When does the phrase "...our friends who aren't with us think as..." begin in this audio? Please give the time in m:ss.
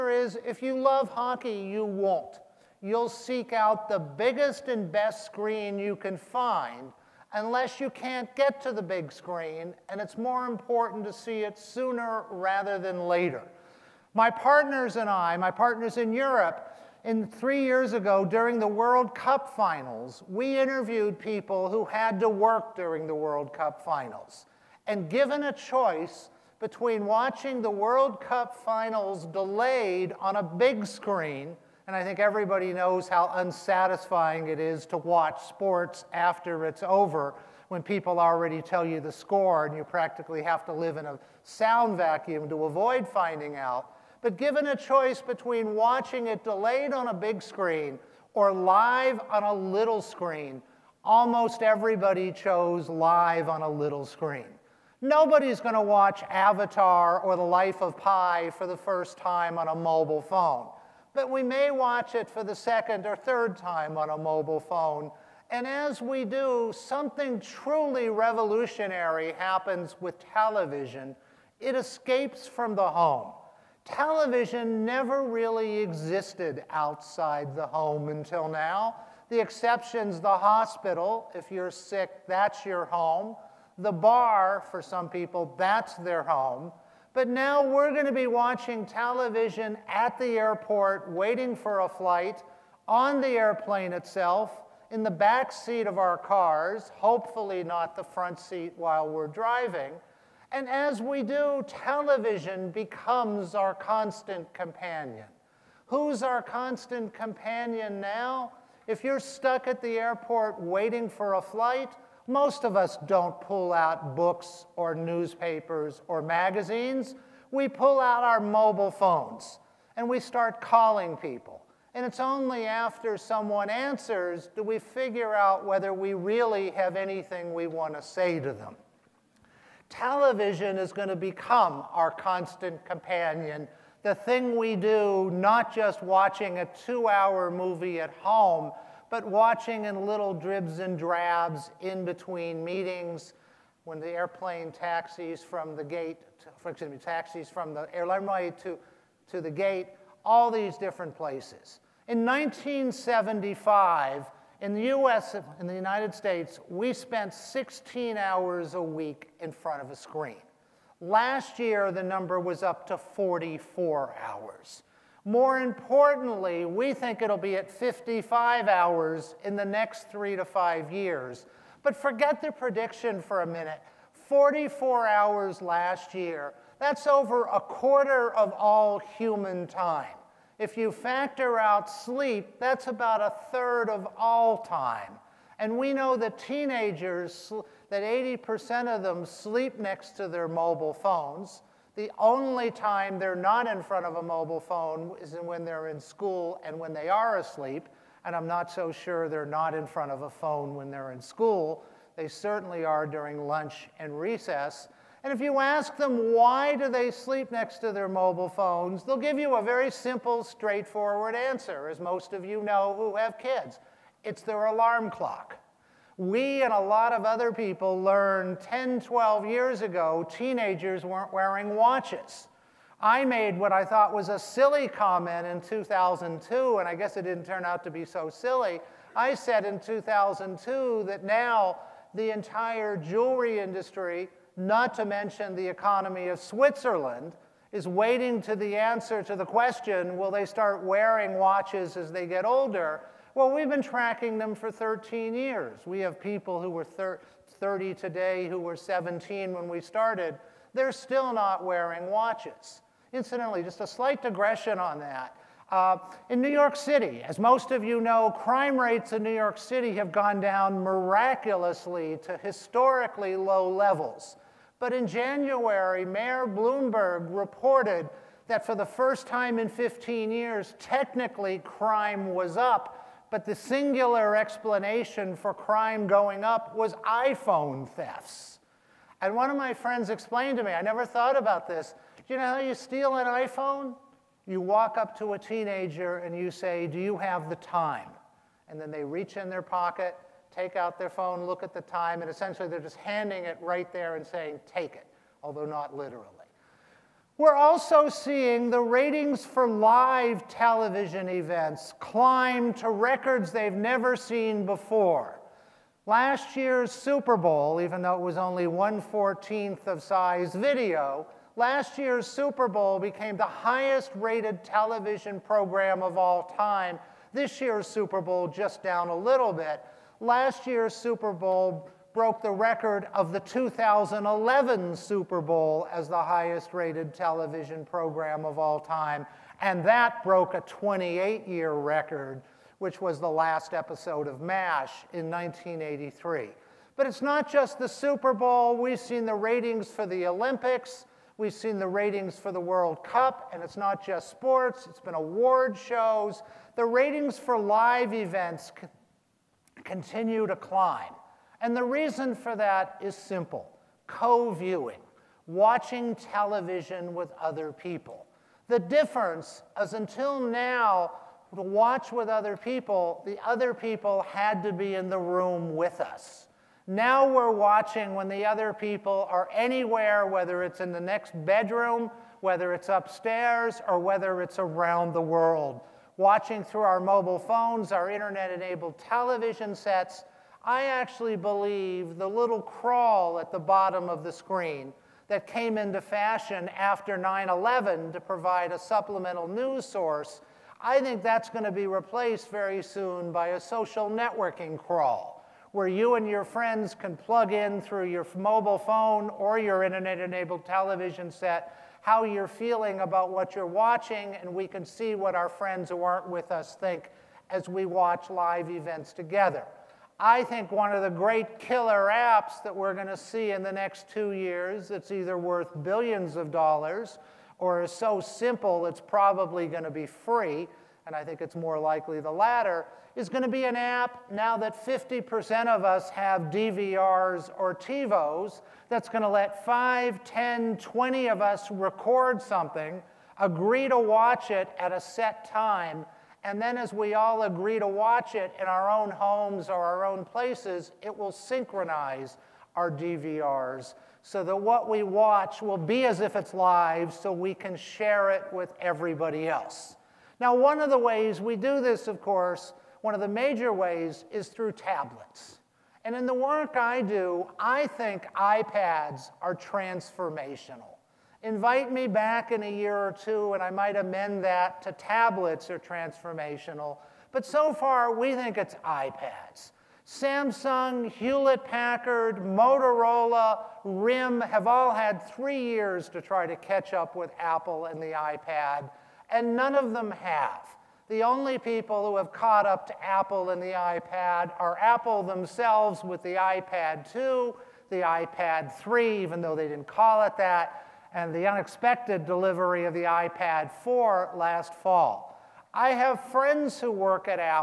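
6:45.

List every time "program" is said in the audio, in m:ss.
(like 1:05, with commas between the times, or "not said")
5:15, 5:27.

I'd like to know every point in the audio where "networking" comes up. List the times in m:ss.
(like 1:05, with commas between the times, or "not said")
6:34.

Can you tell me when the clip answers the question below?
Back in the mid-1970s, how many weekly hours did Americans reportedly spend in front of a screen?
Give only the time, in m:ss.
2:37.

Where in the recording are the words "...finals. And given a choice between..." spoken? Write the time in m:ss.
0:23.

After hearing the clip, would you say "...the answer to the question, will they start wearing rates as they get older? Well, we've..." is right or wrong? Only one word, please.
wrong.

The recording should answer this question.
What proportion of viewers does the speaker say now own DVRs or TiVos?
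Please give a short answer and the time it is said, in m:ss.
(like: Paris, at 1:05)
50%, at 7:04.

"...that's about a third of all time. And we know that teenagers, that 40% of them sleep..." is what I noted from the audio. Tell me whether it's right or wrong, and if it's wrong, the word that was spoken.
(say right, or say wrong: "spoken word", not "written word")
wrong: "80", not "40".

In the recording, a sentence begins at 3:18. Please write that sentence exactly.
And I'm not so sure they're not in front of a phone when they're in school.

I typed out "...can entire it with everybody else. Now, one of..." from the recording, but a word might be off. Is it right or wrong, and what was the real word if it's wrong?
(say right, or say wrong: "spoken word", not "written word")
wrong: "share", not "entire".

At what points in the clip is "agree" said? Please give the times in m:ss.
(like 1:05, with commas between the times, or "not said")
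7:13, 7:17.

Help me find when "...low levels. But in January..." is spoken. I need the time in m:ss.
4:23.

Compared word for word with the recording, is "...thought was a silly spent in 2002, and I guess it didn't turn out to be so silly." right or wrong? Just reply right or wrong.
wrong.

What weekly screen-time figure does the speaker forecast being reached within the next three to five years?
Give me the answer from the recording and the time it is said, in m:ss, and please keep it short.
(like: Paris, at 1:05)
55 hours, at 2:47.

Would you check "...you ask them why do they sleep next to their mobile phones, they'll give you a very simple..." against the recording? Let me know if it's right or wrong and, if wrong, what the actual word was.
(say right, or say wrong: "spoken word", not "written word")
right.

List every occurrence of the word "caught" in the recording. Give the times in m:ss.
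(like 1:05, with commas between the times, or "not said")
8:02.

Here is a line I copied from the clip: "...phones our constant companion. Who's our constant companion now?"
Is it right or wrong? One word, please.
wrong.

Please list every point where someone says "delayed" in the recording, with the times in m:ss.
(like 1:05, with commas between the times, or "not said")
0:29, 0:46.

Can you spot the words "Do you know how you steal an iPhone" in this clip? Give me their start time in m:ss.
4:42.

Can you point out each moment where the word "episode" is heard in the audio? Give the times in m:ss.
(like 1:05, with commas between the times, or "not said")
5:33.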